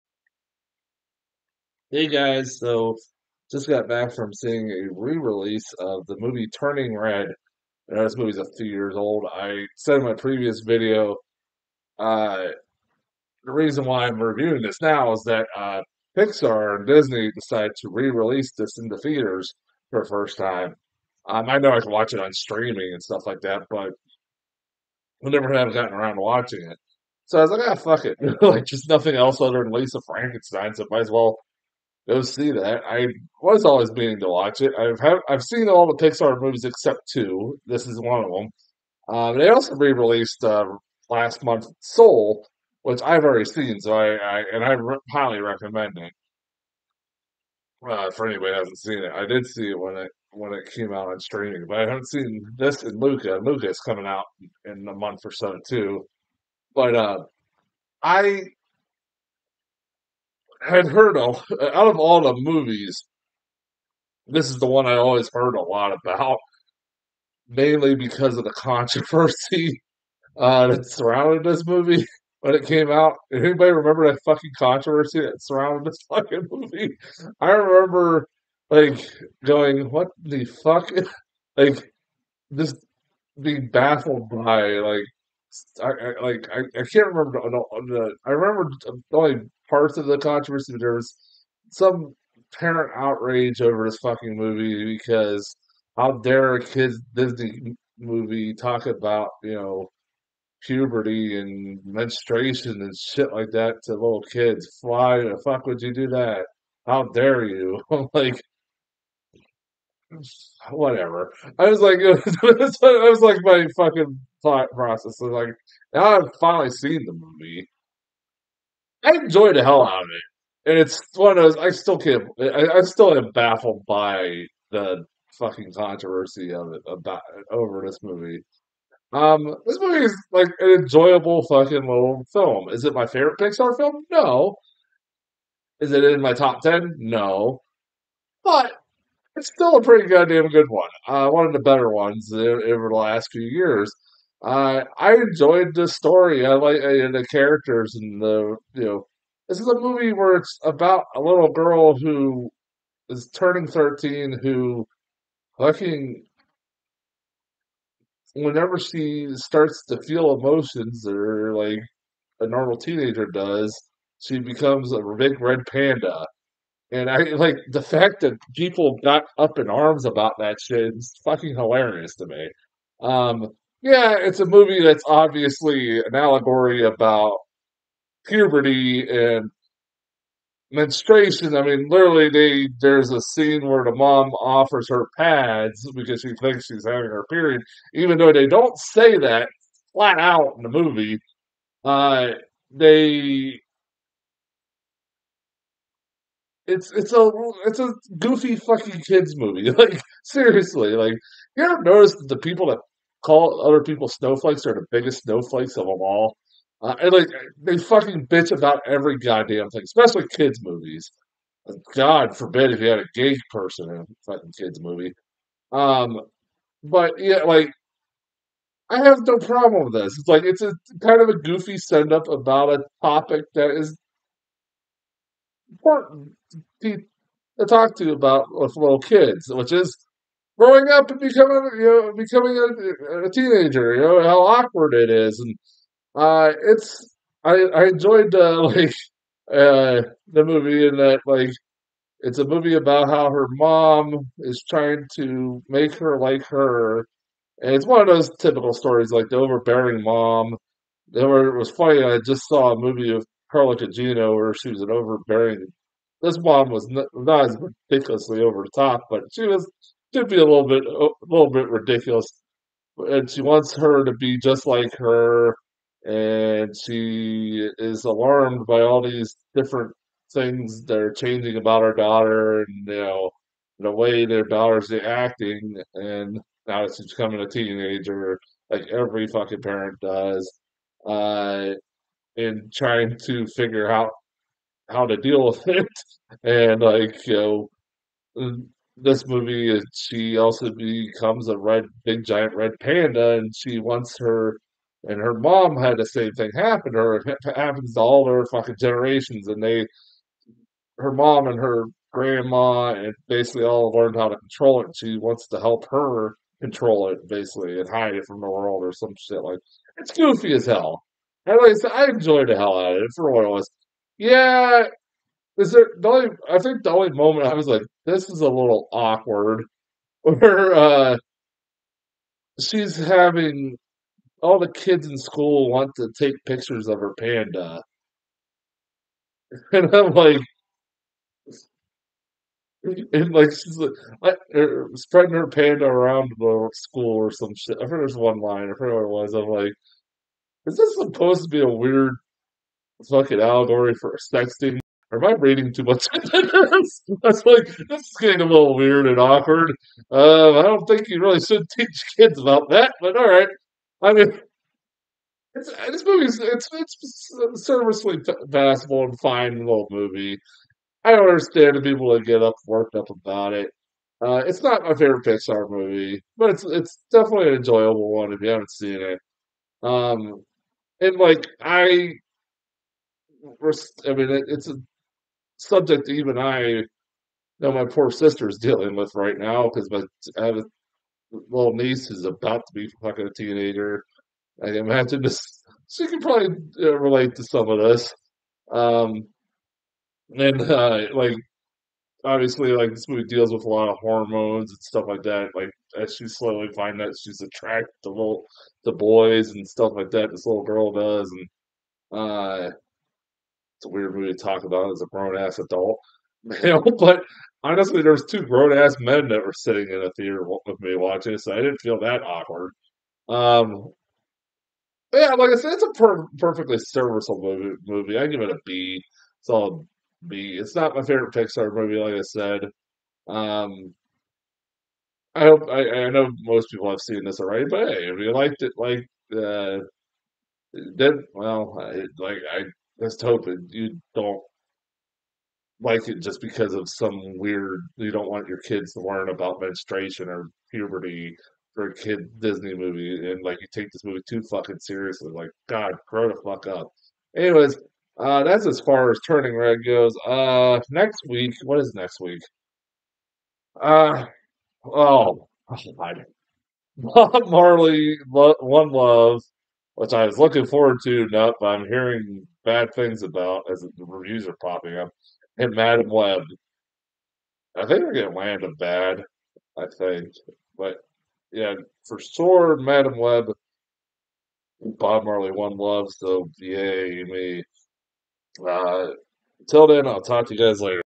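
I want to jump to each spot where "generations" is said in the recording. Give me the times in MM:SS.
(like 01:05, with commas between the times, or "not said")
04:58.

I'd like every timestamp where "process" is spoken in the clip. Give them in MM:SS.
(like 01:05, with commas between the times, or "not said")
01:54.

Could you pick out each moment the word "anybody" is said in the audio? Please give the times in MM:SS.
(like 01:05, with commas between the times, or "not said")
00:48, 01:13.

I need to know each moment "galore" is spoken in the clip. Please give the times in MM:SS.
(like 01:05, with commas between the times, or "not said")
not said.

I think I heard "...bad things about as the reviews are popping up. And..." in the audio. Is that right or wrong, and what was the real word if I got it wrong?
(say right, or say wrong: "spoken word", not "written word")
right.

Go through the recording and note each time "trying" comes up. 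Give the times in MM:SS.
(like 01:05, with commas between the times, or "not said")
04:04, 04:42.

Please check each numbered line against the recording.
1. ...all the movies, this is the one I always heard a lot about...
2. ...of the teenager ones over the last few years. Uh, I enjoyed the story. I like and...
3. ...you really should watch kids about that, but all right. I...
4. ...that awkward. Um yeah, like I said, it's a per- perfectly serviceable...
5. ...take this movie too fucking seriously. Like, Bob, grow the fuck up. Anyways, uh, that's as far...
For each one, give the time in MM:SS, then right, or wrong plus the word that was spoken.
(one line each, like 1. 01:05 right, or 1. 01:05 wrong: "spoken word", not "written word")
1. 01:01 right
2. 02:21 wrong: "better", not "teenager"
3. 05:51 wrong: "teach", not "watch"
4. 06:52 right
5. 07:23 wrong: "God", not "Bob".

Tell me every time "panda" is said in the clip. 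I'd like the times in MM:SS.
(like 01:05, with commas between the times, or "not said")
02:45, 04:52, 05:27, 05:35.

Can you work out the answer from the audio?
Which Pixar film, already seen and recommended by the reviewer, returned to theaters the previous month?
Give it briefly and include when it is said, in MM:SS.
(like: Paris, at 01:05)
Soul, at 00:41.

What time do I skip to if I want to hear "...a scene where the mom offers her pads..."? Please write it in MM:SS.
03:03.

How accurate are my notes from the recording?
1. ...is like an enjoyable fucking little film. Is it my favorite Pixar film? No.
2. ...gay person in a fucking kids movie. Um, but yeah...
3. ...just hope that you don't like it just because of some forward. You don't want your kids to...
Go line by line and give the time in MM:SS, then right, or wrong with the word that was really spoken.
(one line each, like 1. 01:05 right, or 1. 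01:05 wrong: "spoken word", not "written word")
1. 02:10 right
2. 03:33 right
3. 07:13 wrong: "weird", not "forward".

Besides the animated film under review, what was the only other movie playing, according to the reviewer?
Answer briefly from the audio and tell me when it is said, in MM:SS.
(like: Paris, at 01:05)
Lisa Frankenstein, at 00:29.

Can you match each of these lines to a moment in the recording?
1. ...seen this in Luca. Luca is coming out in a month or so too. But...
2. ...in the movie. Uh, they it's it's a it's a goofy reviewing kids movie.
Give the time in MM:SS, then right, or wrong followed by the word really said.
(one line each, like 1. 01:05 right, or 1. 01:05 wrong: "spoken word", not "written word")
1. 00:52 right
2. 03:10 wrong: "fucking", not "reviewing".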